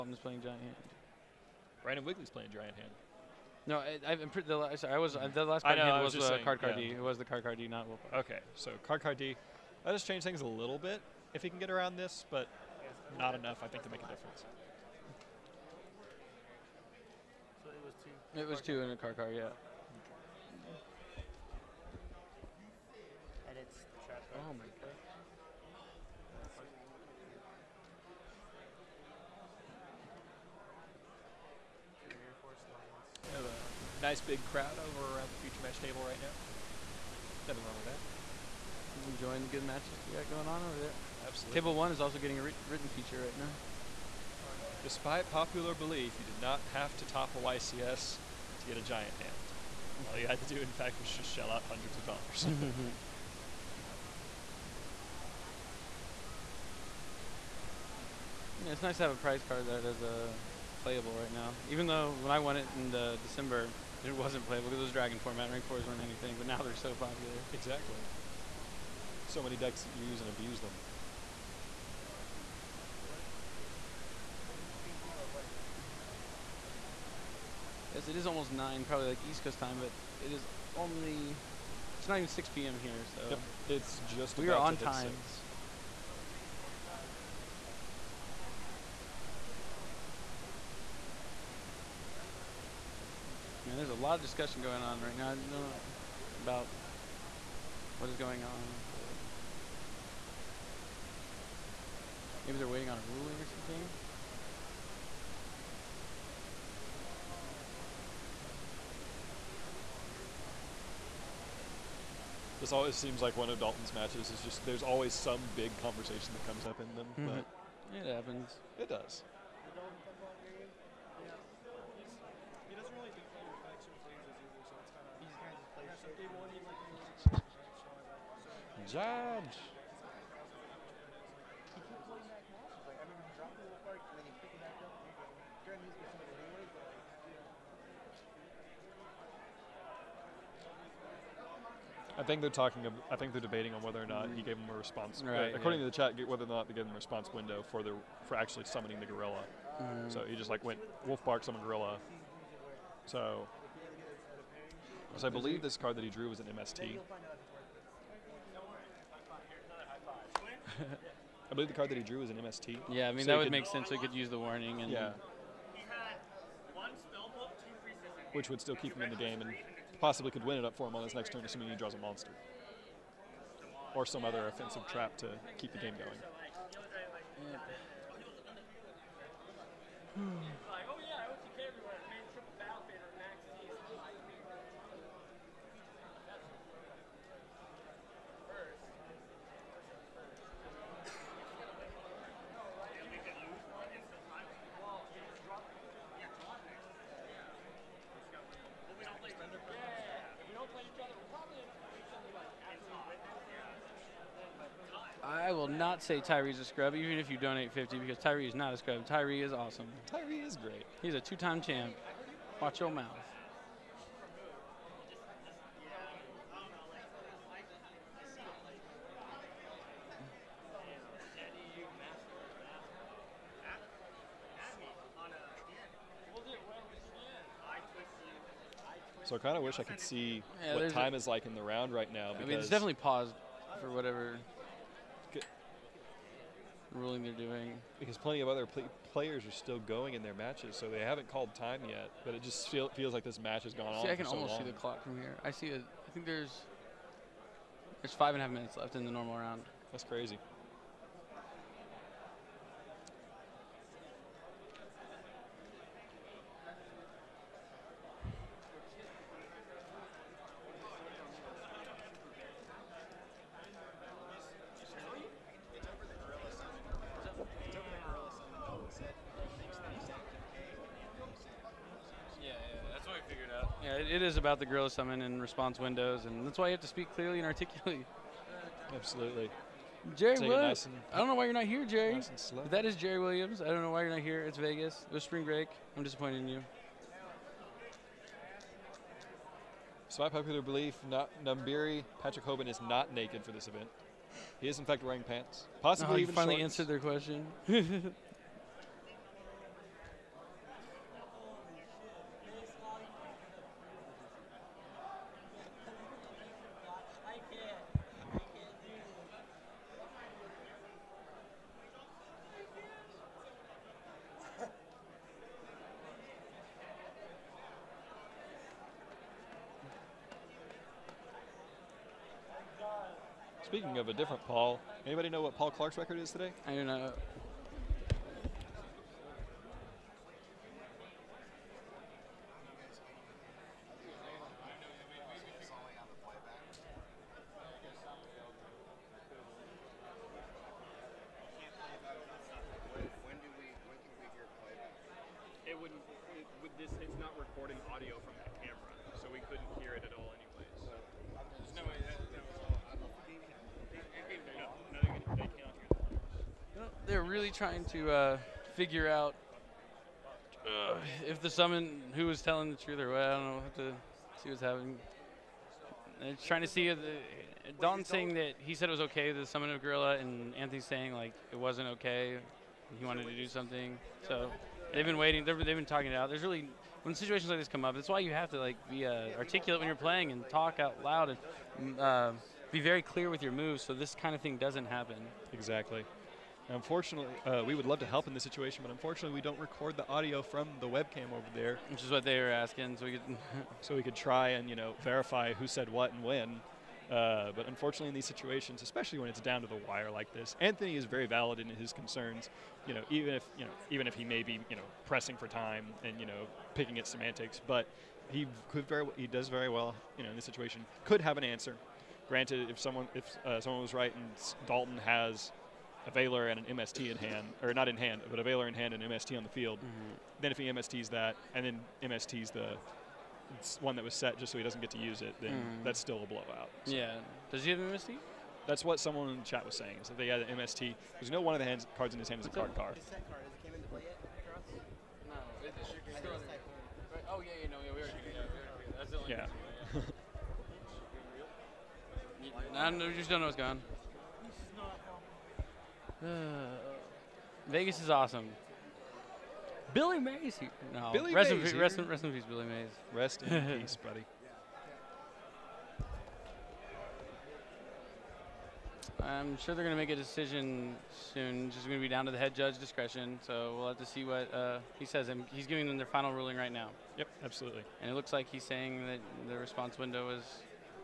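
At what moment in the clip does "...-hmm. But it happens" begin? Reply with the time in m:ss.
1:57.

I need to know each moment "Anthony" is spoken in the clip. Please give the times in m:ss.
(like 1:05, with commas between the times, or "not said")
6:10, 6:40.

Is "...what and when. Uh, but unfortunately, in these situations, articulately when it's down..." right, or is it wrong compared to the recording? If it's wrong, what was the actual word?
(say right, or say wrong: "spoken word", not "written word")
wrong: "especially", not "articulately".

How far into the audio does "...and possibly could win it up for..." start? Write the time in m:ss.
2:49.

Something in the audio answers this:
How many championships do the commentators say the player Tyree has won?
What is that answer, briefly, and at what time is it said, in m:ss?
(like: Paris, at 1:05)
2, at 3:31.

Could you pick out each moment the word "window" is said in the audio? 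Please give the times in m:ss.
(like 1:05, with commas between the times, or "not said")
2:27, 4:35, 7:49.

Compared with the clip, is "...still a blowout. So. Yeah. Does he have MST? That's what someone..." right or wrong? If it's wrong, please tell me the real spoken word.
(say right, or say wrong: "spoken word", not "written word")
right.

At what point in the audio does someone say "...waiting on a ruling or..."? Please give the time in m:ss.
1:42.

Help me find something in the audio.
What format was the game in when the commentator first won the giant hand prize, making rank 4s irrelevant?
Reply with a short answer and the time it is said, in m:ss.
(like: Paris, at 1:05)
Dragon format, at 1:04.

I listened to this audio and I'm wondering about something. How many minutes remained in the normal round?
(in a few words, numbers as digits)
5.5.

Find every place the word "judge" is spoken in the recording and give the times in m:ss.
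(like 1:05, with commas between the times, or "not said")
2:08, 7:42.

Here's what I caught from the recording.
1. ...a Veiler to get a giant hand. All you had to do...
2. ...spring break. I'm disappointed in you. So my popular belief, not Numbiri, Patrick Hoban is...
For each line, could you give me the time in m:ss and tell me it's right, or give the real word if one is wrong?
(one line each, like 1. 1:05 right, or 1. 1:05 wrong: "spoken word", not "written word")
1. 0:47 wrong: "YCS", not "Veiler"
2. 4:45 right.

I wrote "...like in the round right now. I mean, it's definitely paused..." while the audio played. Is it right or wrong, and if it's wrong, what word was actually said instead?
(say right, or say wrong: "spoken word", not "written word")
right.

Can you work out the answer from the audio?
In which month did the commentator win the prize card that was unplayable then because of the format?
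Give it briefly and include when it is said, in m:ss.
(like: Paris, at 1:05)
December, at 1:03.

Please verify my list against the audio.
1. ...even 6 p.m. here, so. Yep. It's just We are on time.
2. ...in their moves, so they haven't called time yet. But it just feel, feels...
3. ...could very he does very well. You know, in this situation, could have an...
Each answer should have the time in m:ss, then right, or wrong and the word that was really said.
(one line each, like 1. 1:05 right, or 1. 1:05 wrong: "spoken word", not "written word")
1. 1:22 right
2. 4:00 wrong: "matches", not "moves"
3. 6:48 right.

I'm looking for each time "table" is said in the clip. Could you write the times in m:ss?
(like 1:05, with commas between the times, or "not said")
0:35, 0:41.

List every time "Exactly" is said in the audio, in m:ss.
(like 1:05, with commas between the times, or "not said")
1:07, 6:25.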